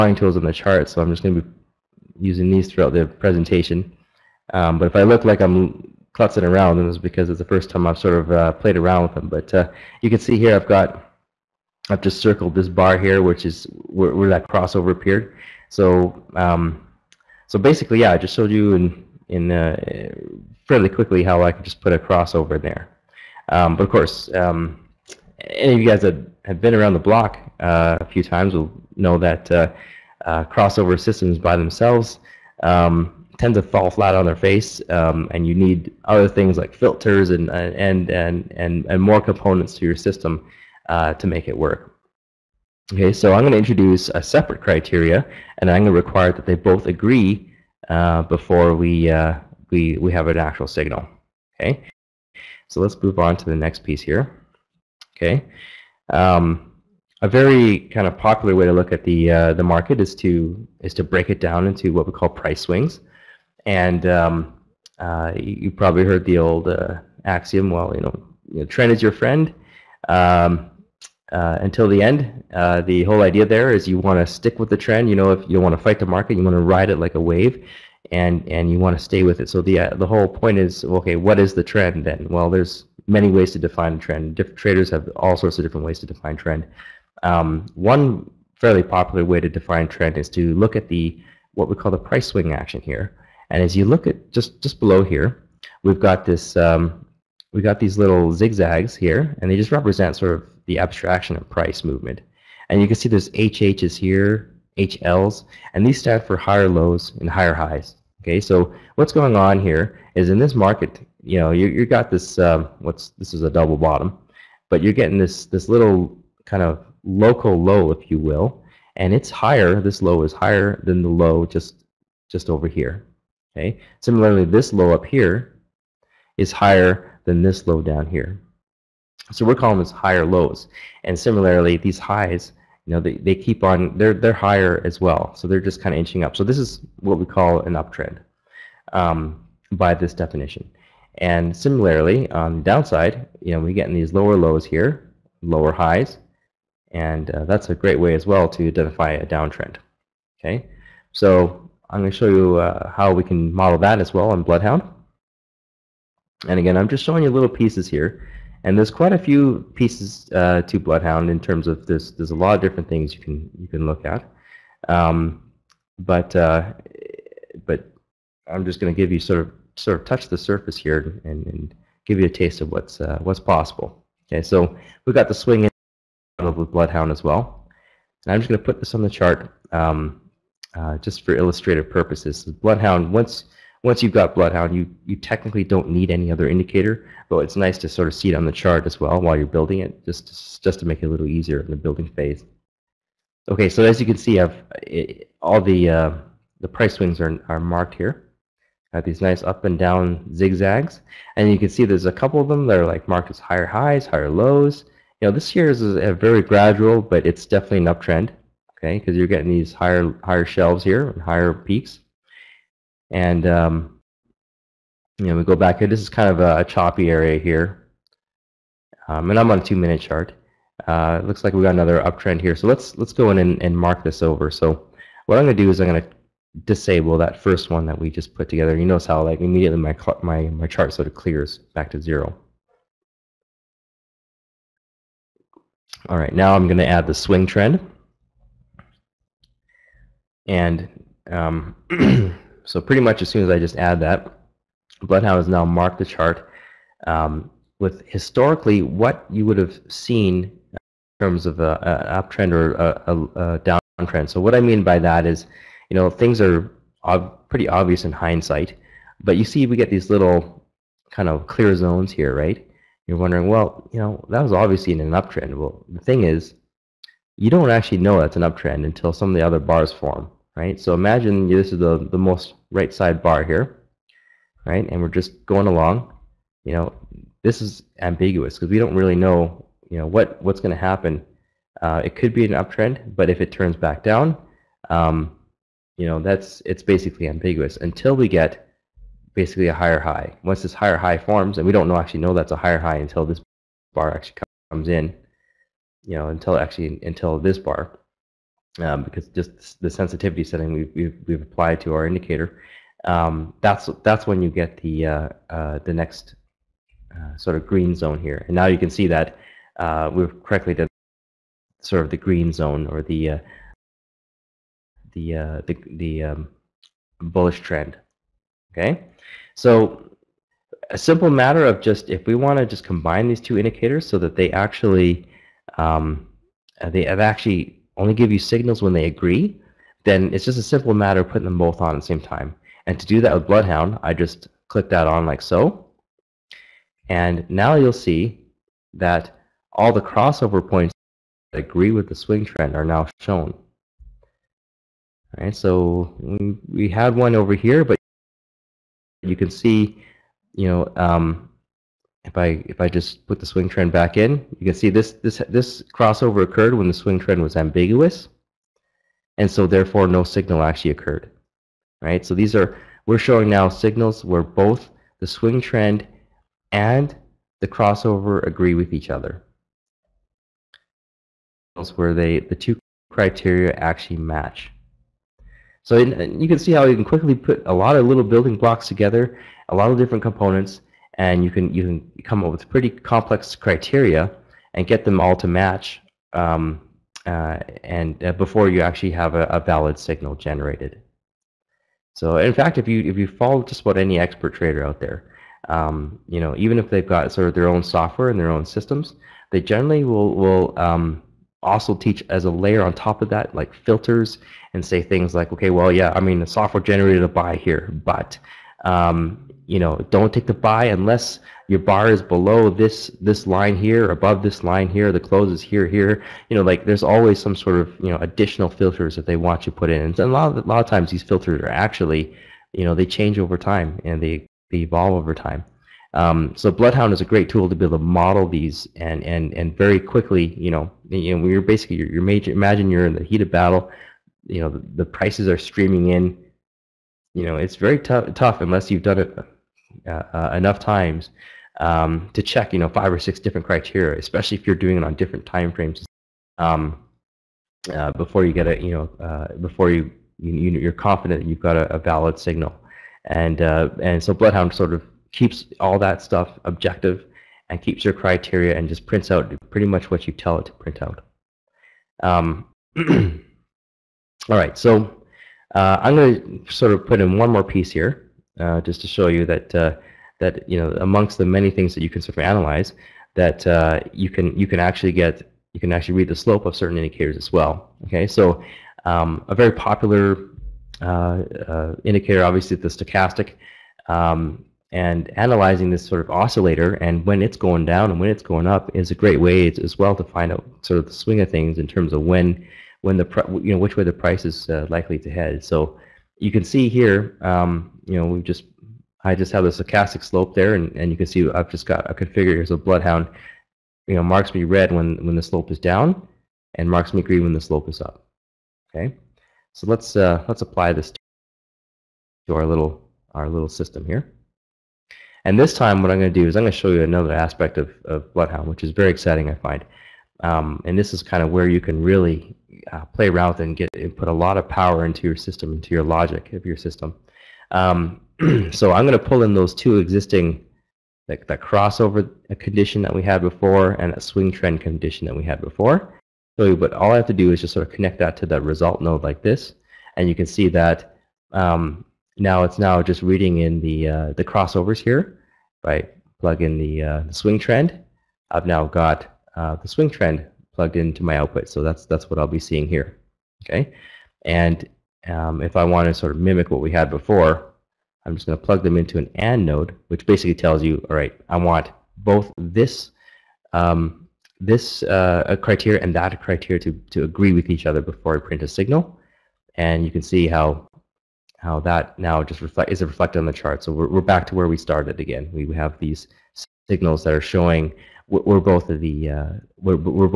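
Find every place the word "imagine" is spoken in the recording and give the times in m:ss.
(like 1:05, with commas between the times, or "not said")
4:30, 7:12.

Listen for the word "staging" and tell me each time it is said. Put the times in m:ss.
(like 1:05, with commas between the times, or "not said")
not said.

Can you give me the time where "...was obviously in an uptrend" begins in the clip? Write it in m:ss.
4:24.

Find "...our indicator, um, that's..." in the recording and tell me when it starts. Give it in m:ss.
5:01.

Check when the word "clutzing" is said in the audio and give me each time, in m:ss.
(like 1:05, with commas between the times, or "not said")
0:06.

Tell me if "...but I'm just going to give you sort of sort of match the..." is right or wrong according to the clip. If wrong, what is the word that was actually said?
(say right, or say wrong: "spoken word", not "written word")
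wrong: "touch", not "match".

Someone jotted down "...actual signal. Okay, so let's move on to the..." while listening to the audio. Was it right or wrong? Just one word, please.
right.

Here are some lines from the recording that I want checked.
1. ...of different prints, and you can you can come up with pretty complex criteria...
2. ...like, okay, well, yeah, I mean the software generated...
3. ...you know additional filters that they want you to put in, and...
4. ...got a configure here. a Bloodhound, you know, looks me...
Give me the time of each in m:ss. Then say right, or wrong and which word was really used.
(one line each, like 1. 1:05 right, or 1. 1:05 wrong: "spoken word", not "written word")
1. 6:19 wrong: "components", not "prints"
2. 6:45 right
3. 6:58 right
4. 8:21 wrong: "marks", not "looks".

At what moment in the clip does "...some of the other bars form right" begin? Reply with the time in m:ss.
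4:29.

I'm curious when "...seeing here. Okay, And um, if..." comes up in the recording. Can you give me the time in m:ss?
9:12.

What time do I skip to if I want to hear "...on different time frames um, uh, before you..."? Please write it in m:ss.
7:25.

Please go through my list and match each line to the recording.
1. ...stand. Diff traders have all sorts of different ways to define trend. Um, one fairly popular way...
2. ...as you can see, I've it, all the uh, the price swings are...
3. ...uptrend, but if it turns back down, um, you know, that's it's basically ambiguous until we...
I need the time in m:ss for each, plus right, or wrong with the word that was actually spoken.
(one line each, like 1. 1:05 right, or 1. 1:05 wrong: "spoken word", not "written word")
1. 1:23 wrong: "trend", not "stand"
2. 3:13 right
3. 4:42 right.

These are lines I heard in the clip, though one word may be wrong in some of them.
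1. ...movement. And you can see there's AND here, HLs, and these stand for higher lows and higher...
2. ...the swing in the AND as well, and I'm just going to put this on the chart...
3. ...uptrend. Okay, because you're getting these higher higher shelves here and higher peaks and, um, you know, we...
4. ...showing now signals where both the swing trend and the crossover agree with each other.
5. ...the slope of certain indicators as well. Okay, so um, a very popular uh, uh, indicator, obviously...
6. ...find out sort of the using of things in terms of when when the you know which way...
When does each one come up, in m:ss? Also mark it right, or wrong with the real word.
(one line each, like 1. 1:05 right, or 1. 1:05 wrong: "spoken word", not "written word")
1. 1:41 wrong: "HHs", not "AND"
2. 2:55 wrong: "Bloodhound", not "AND"
3. 3:27 right
4. 6:03 right
5. 7:56 right
6. 8:10 wrong: "swing", not "using".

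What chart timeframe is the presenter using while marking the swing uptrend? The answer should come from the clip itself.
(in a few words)
2-minute.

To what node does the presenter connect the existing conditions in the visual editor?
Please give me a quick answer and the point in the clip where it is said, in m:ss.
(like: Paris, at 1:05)
Result node, at 8:58.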